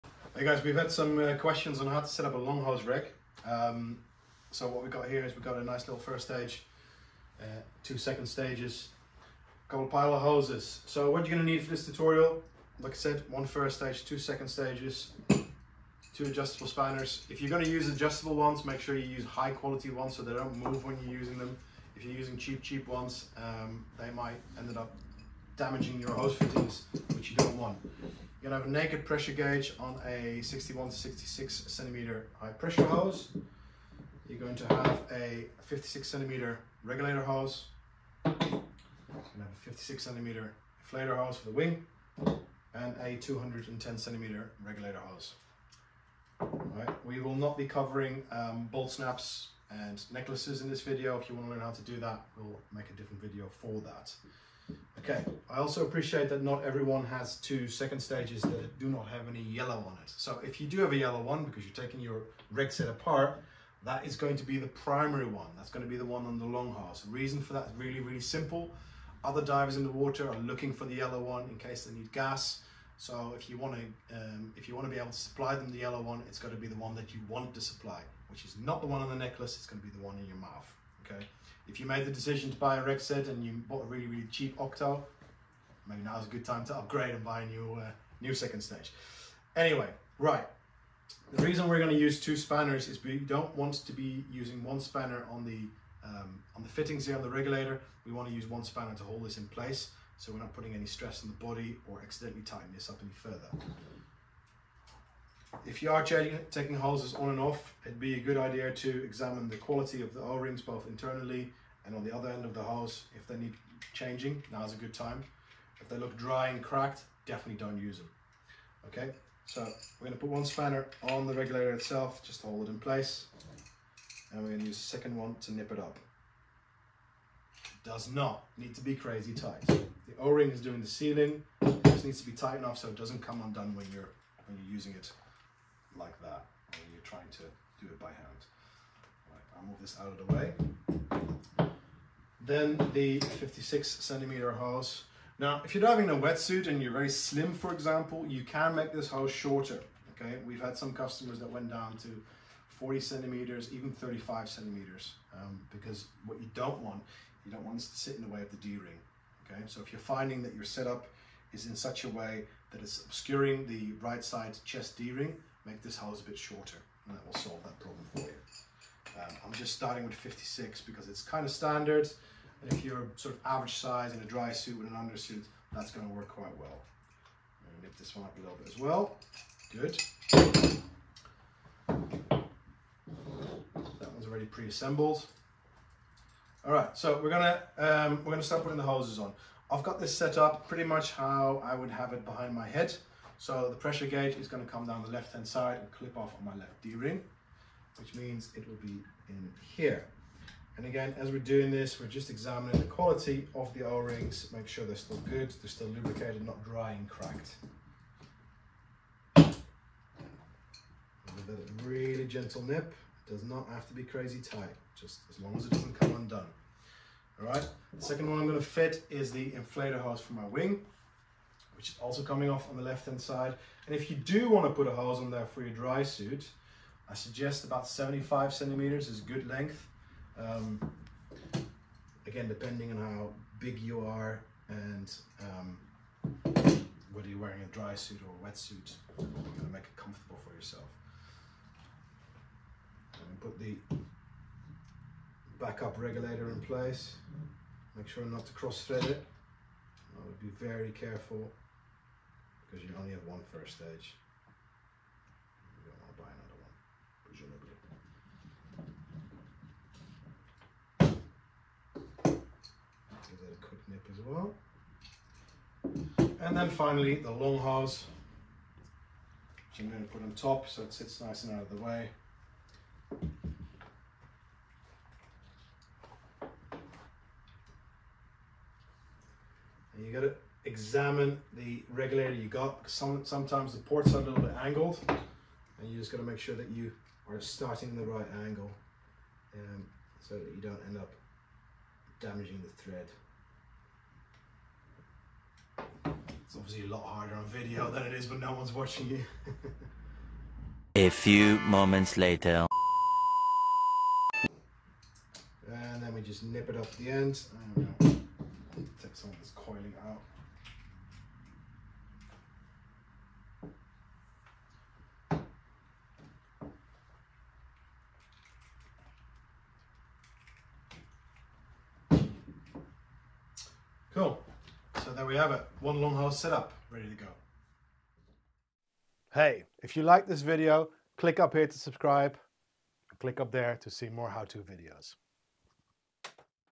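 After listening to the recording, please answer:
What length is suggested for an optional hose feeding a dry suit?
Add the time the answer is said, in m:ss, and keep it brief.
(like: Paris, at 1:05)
75 centimeters, at 3:47.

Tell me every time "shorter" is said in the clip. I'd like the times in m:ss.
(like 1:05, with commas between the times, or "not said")
2:29, 2:46.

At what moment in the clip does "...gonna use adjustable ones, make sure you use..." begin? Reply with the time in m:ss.
0:17.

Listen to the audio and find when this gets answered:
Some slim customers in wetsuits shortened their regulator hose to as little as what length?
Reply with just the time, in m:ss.
2:33.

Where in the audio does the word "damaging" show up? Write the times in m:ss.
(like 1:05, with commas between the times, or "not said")
0:25, 4:52.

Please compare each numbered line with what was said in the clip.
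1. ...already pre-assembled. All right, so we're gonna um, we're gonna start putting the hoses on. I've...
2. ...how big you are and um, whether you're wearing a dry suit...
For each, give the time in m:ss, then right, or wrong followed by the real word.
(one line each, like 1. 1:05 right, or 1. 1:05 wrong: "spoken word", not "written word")
1. 3:04 right
2. 3:52 right.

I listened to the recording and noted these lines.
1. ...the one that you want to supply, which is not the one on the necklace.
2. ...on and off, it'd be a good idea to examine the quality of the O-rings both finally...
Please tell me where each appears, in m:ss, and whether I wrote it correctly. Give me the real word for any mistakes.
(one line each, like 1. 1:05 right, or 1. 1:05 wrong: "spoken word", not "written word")
1. 1:16 right
2. 1:47 wrong: "internally", not "finally".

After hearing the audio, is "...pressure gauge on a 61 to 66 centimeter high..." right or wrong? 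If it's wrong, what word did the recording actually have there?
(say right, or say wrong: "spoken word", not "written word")
right.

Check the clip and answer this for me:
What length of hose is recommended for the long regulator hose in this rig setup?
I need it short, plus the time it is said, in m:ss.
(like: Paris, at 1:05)
210 centimeters, at 0:43.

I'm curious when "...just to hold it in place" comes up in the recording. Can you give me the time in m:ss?
2:02.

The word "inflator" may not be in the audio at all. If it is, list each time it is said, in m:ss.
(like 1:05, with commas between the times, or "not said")
0:40, 3:39.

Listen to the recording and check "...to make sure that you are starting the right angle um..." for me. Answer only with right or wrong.
right.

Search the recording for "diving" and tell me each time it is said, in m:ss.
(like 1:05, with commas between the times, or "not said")
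2:25.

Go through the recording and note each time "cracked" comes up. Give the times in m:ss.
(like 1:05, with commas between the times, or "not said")
1:56, 3:27.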